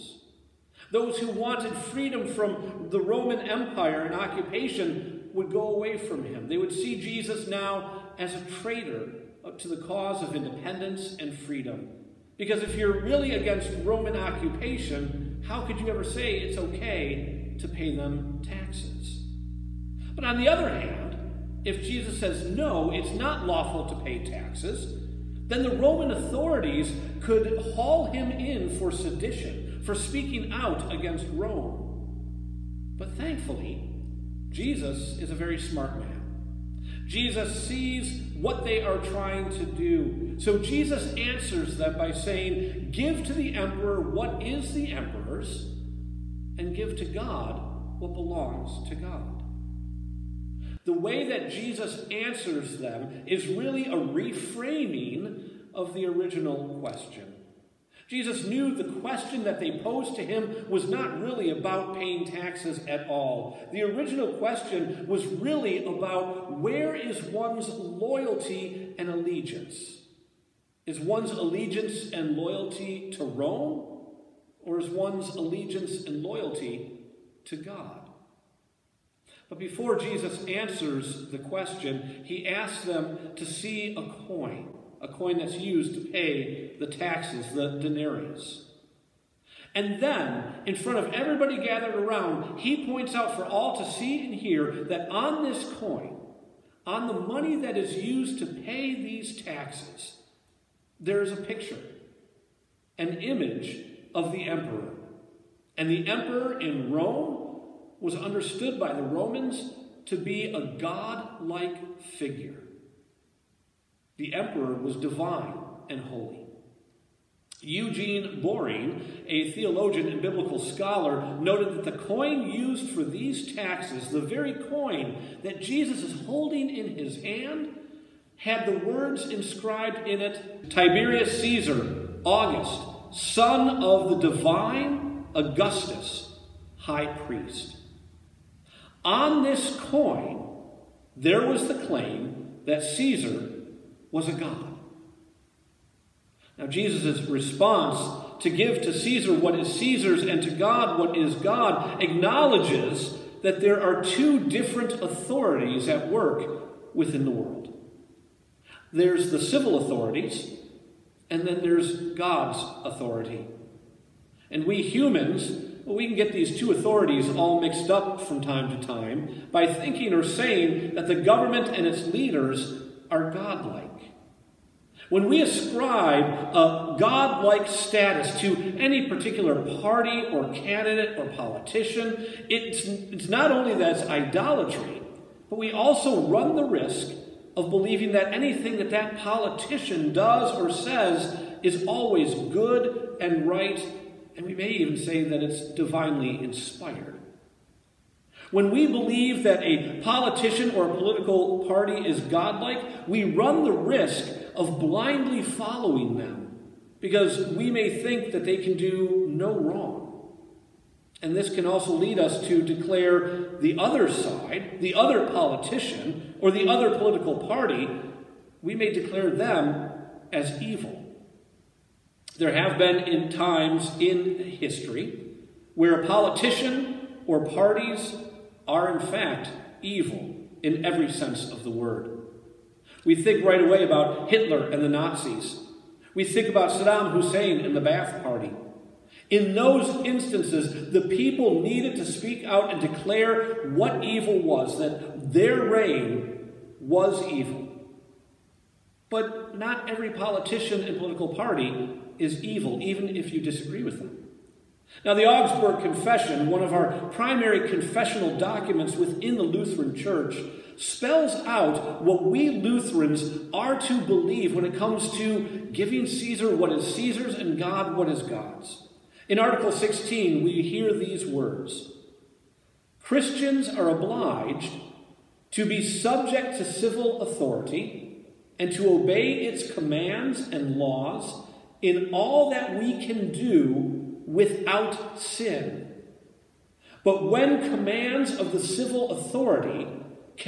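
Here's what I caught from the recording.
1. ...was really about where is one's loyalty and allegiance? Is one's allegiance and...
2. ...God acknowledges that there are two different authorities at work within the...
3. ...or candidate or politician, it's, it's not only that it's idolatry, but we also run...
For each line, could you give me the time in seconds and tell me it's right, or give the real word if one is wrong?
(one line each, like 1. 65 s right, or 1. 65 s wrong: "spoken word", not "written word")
1. 65 s right
2. 151 s right
3. 180 s right.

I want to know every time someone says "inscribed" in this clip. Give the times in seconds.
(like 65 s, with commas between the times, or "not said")
129 s.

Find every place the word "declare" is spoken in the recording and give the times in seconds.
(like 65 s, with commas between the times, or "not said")
212 s, 218 s, 242 s.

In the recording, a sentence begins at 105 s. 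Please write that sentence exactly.
And the emperor in Rome was understood by the Romans to be a god like figure.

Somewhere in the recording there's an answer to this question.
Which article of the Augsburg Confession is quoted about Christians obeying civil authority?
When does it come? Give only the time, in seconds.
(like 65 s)
269 s.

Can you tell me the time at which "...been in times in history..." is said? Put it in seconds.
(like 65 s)
222 s.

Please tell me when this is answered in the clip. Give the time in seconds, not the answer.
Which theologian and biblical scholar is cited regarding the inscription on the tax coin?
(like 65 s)
117 s.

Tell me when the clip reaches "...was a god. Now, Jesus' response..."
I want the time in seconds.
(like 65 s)
144 s.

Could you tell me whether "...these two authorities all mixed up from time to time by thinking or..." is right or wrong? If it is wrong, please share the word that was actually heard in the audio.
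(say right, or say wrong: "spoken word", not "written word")
right.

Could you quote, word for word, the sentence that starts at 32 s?
But thankfully, Jesus is a very smart man.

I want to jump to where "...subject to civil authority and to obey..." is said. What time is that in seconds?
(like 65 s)
275 s.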